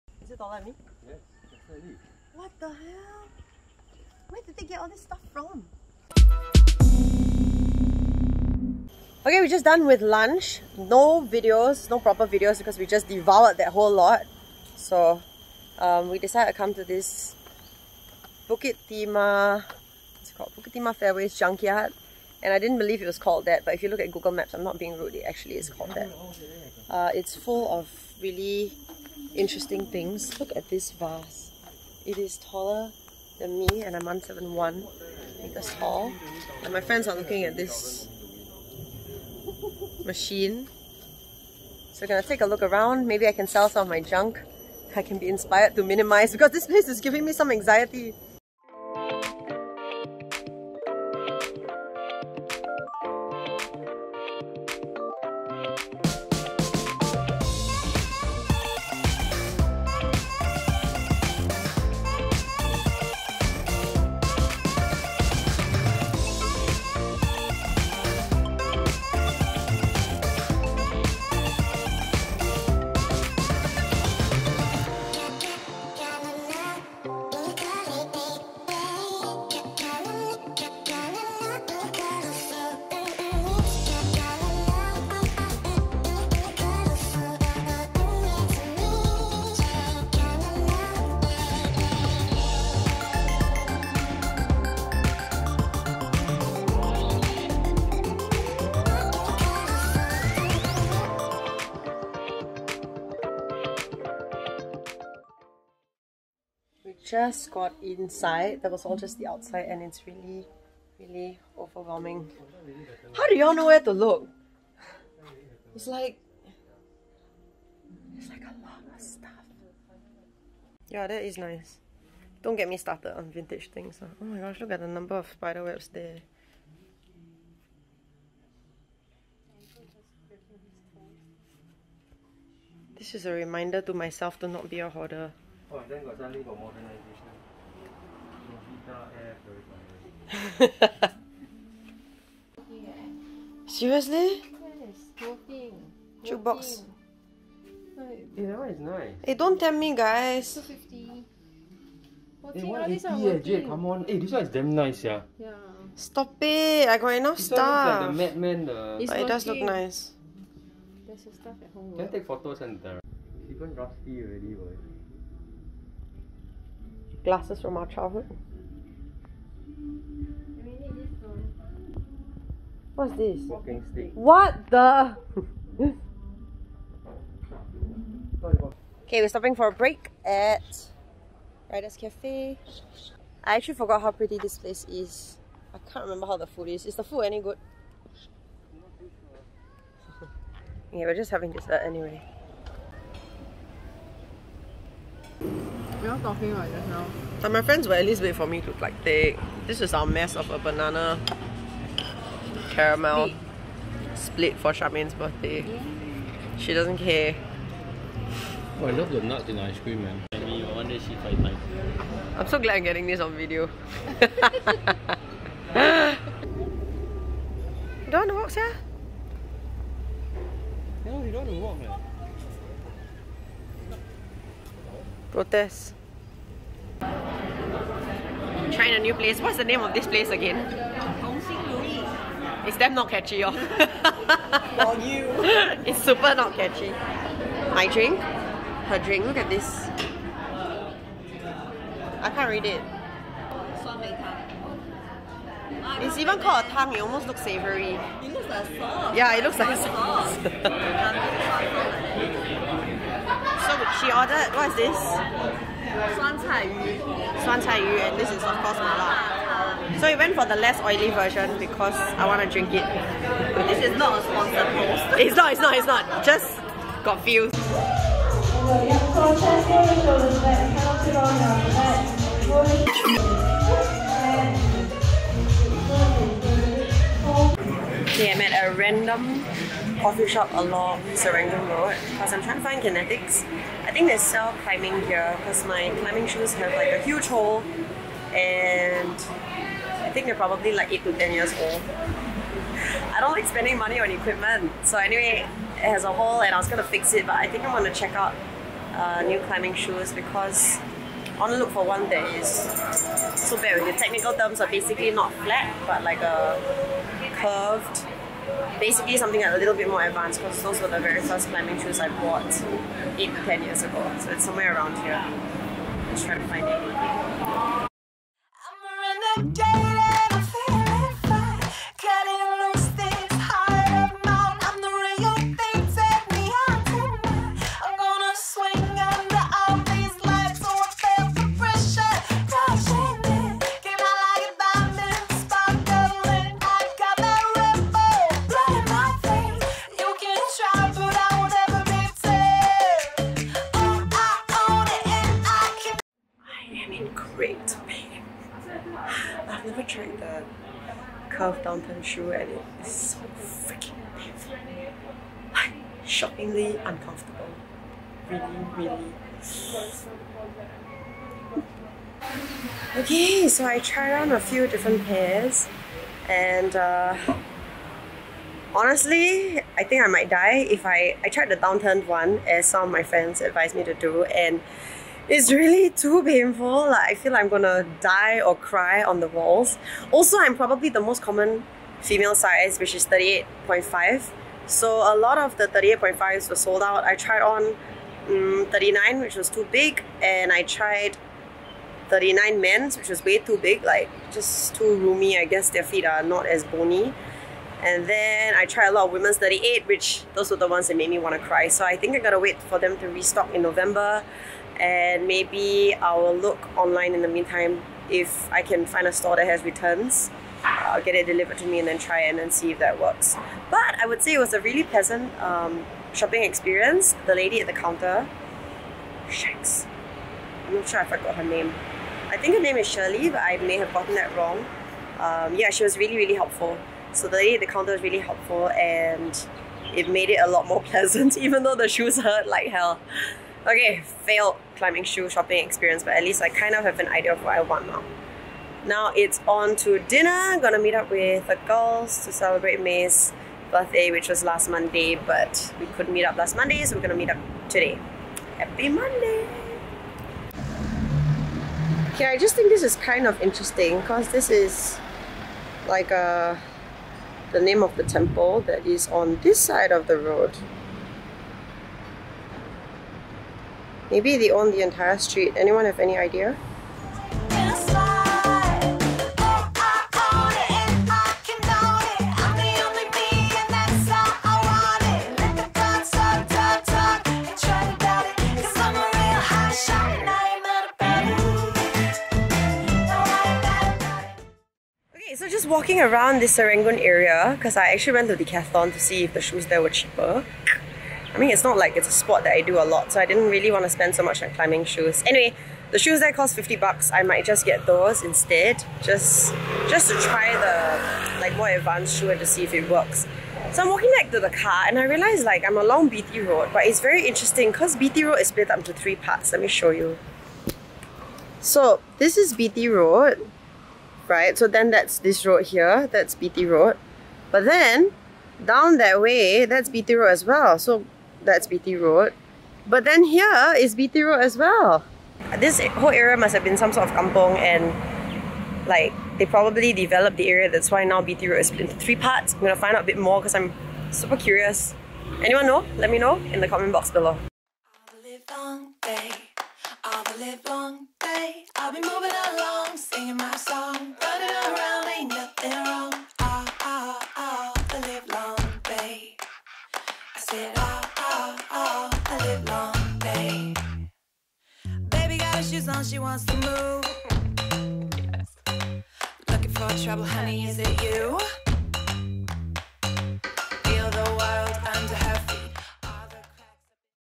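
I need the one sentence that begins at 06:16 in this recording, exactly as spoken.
Like I feel like I'm gonna die or cry on the walls.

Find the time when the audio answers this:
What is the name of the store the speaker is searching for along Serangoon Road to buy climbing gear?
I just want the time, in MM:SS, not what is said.
04:42.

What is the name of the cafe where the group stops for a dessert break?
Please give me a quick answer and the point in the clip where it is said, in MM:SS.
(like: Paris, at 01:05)
Riders Cafe, at 03:01.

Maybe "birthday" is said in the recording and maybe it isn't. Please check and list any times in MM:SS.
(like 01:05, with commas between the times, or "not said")
03:25, 07:23.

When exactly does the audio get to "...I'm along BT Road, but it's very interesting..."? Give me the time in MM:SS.
08:25.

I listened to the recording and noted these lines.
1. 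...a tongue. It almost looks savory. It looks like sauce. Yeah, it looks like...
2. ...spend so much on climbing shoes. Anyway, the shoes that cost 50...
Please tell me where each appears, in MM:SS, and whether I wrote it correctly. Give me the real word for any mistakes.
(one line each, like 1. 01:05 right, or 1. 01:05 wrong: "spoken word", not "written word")
1. 04:06 right
2. 08:13 right.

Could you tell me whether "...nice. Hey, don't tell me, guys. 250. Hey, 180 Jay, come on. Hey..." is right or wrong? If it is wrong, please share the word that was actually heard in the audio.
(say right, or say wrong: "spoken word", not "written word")
right.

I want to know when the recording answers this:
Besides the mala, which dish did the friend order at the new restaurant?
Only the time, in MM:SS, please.
04:16.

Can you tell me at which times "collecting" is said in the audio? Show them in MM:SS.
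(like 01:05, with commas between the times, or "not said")
not said.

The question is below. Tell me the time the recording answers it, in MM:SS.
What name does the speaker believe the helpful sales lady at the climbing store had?
07:02.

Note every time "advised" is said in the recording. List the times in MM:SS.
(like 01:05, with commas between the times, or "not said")
06:13.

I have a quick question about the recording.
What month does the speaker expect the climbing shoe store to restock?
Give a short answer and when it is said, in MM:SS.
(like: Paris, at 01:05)
November, at 06:43.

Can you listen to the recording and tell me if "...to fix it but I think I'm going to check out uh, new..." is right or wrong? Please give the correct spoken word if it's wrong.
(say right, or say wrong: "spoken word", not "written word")
right.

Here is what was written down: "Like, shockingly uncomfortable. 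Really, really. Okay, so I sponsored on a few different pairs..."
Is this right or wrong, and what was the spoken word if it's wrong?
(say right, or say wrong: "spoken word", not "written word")
wrong: "tried", not "sponsored".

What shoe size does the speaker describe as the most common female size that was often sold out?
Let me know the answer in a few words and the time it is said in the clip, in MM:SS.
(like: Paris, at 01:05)
38.5, at 06:23.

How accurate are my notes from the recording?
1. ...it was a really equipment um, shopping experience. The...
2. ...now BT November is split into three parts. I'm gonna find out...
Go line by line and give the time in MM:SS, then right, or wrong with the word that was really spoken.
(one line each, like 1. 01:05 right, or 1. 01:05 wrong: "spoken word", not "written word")
1. 06:54 wrong: "pleasant", not "equipment"
2. 08:51 wrong: "Road", not "November".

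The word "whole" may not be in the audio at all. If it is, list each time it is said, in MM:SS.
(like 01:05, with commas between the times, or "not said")
00:13, 08:45.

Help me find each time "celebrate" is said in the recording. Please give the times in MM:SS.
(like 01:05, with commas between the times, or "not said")
07:22.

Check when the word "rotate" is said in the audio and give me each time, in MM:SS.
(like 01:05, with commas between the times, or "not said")
not said.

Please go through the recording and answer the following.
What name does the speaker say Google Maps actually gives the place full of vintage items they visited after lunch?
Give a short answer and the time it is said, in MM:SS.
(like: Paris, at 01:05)
Bukit Timah Fairways Junkyard, at 00:20.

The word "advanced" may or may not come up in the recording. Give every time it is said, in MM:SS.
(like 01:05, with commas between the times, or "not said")
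05:10, 08:21.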